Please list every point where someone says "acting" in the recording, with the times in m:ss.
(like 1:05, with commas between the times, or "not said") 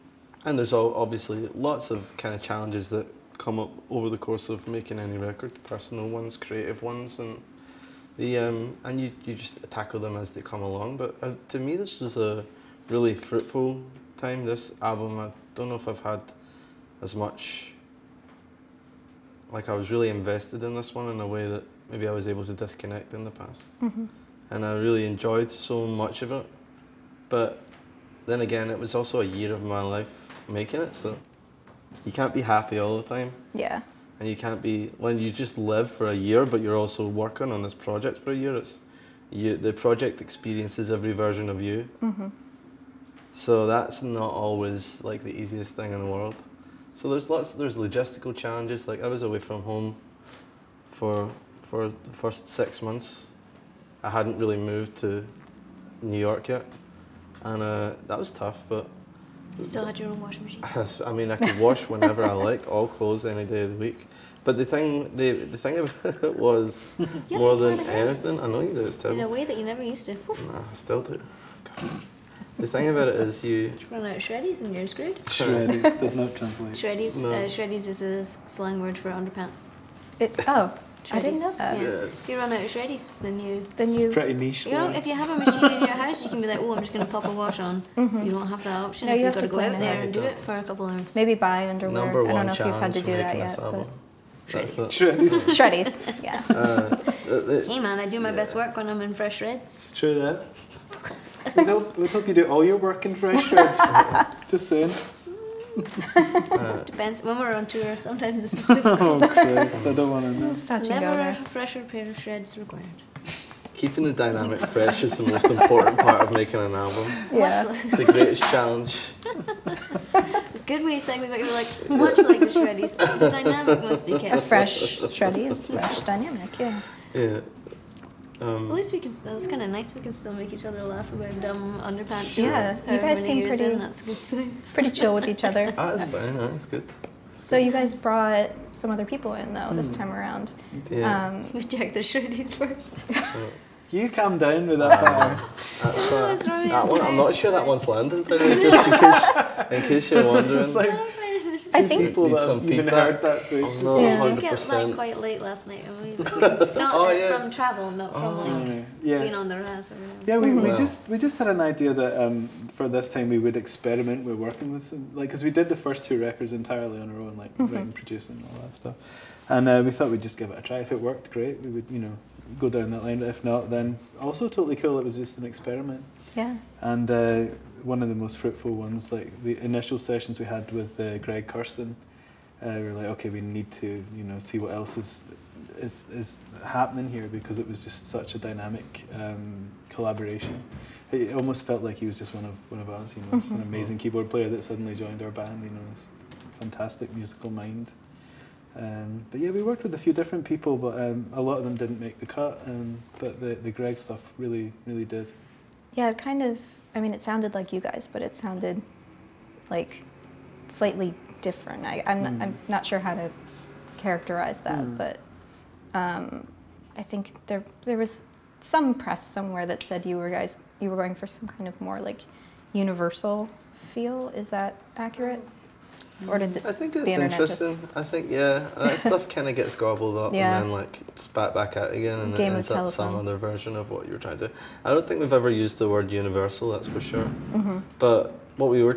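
not said.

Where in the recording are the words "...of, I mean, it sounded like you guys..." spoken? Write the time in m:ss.
3:26.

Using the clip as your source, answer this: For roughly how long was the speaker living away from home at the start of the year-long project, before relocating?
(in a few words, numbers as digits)
6 months.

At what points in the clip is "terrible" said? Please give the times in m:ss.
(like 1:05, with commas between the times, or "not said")
1:08.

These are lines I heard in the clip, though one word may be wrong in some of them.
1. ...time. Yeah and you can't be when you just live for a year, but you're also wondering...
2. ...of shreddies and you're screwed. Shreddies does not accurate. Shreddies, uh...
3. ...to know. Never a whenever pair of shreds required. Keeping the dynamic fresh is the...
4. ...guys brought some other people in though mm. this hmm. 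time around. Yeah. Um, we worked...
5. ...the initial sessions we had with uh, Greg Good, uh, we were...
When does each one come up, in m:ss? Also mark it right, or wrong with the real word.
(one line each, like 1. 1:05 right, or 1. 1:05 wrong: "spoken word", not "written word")
1. 0:33 wrong: "working", not "wondering"
2. 1:14 wrong: "translate", not "accurate"
3. 1:50 wrong: "fresher", not "whenever"
4. 2:17 wrong: "checked", not "worked"
5. 2:59 wrong: "Kurstin", not "Good".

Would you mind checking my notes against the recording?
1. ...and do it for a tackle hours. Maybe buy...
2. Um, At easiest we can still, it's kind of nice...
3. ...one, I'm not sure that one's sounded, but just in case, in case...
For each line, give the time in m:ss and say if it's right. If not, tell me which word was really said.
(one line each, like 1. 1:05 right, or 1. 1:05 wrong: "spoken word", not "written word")
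1. 1:30 wrong: "couple", not "tackle"
2. 2:08 wrong: "least", not "easiest"
3. 2:26 wrong: "landed", not "sounded".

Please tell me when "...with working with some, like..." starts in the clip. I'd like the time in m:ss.
2:44.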